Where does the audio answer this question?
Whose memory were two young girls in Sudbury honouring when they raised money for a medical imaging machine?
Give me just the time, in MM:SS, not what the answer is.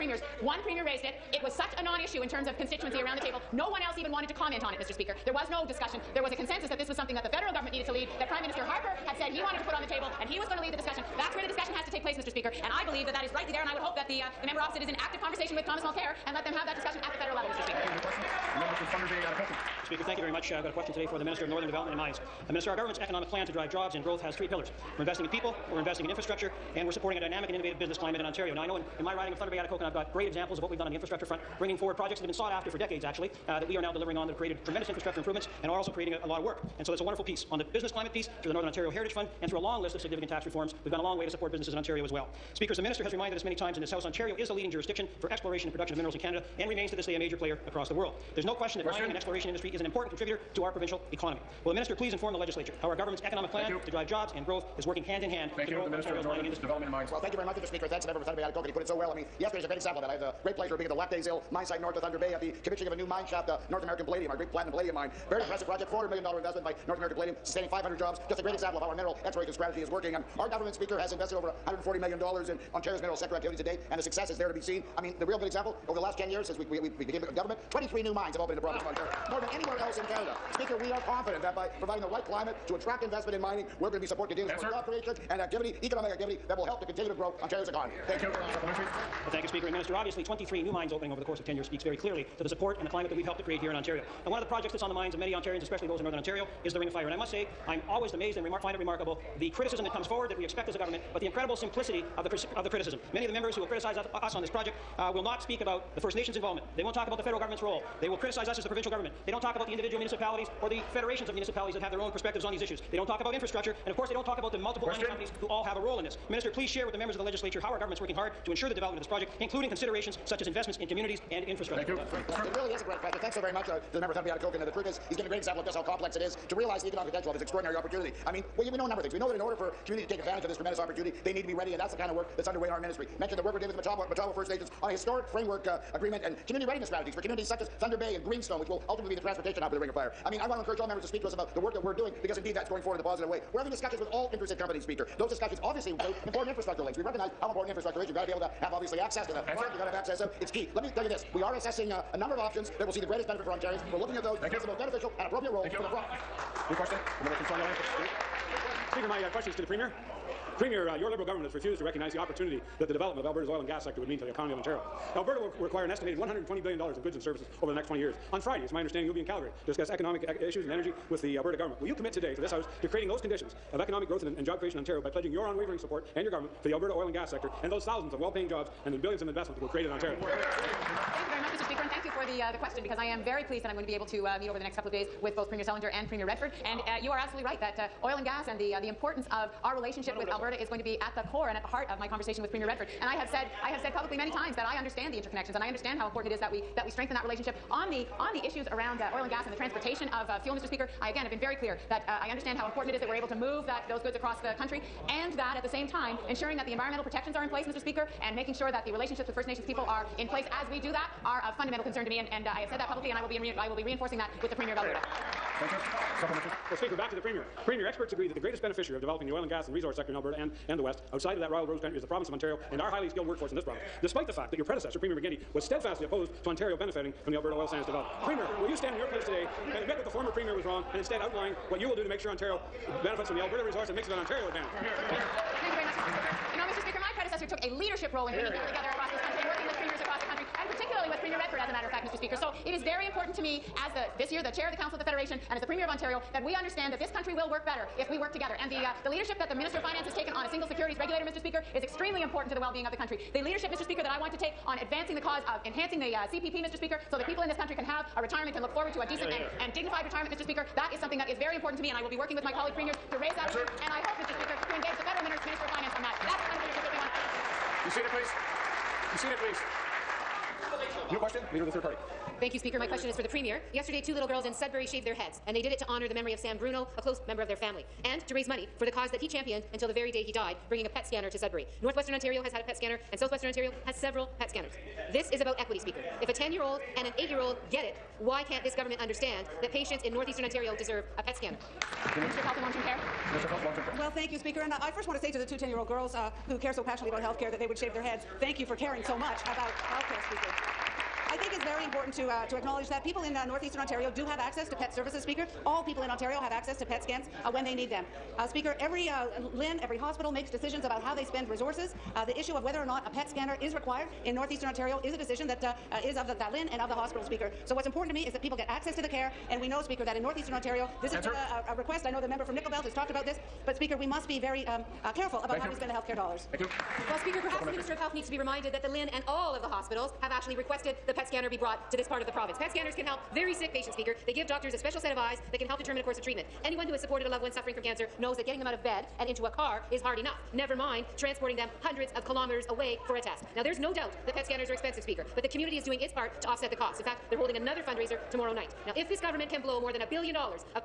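04:36.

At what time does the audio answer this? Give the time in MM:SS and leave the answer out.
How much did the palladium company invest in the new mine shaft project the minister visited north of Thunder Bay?
01:05.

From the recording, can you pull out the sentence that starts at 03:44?
Despite the fact that your predecessor, Premier McGuinty, was steadfastly opposed to Ontario benefiting from the Alberta oil sands development.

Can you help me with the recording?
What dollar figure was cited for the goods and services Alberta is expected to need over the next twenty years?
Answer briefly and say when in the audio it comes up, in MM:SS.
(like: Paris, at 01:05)
$120 billion, at 02:46.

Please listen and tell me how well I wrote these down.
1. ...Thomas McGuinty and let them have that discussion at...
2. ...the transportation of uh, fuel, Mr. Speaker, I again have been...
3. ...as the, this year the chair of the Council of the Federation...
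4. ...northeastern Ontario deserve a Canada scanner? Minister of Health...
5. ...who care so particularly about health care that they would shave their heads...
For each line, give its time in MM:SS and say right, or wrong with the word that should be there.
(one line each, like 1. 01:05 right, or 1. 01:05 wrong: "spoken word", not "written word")
1. 00:15 wrong: "Mulcair", not "McGuinty"
2. 03:19 right
3. 04:03 right
4. 04:50 wrong: "PET", not "Canada"
5. 04:56 wrong: "passionately", not "particularly".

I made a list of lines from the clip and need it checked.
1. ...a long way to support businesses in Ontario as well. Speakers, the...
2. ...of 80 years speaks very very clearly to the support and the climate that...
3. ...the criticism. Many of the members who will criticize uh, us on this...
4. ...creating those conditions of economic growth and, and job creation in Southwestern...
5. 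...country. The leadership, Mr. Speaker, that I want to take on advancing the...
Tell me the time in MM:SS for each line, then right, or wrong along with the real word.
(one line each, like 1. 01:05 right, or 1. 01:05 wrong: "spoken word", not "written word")
1. 00:40 right
2. 01:31 wrong: "10", not "80"
3. 01:42 right
4. 02:52 wrong: "Ontario", not "Southwestern"
5. 04:12 right.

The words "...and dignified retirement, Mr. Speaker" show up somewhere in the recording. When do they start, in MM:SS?
04:19.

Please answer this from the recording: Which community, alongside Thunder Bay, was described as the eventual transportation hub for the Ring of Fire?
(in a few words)
Greenstone.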